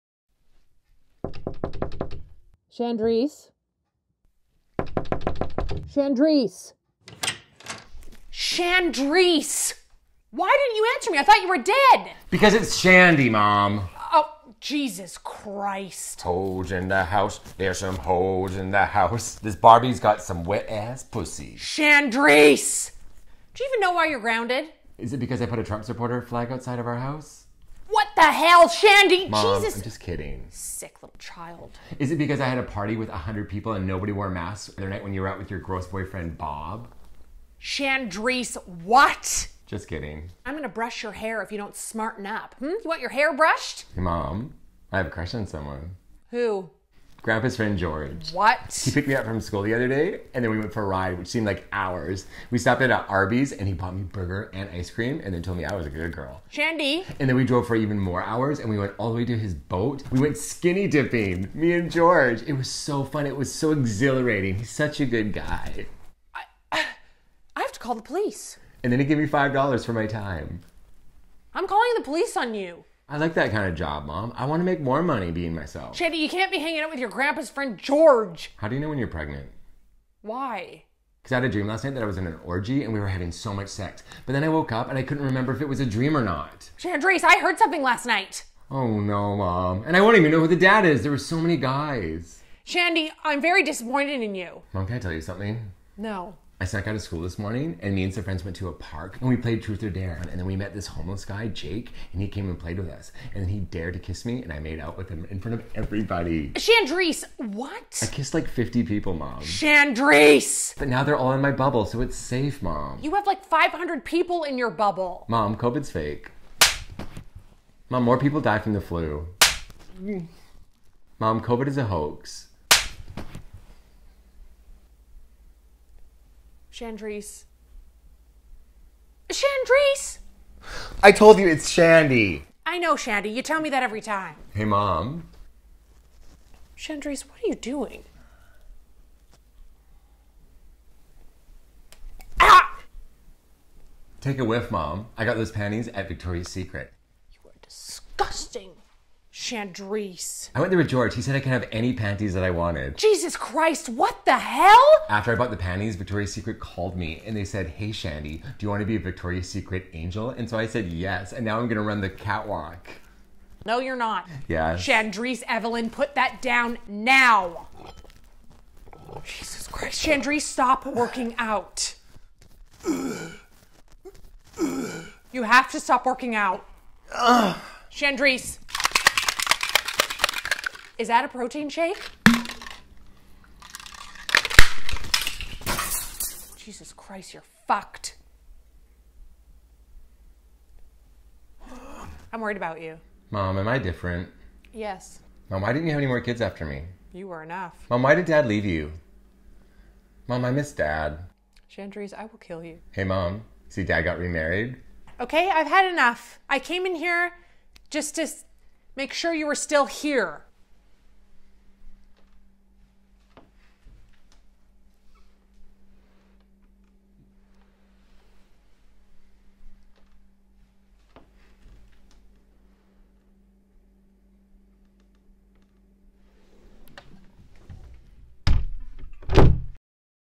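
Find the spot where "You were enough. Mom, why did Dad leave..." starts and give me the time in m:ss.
3:17.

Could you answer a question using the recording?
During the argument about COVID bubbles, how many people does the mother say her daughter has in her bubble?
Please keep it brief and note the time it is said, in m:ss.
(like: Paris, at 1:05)
500, at 1:53.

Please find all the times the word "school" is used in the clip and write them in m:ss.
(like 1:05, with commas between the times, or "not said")
0:49, 1:37.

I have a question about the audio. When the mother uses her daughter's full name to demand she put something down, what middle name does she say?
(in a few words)
Evelyn.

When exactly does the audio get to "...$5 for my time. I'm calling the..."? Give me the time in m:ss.
1:09.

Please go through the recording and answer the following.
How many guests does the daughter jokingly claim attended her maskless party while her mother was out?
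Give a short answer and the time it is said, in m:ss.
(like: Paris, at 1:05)
100, at 0:33.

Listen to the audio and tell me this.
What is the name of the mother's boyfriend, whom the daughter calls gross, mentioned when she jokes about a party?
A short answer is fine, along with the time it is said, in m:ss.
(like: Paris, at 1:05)
Bob, at 0:36.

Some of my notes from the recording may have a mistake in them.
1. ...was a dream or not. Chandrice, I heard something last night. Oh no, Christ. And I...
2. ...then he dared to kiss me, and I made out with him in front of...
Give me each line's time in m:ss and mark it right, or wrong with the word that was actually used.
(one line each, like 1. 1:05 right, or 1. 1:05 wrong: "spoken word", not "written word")
1. 1:25 wrong: "Mom", not "Christ"
2. 1:43 right.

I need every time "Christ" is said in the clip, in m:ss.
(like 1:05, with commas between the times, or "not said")
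0:15, 2:33, 2:49, 3:06.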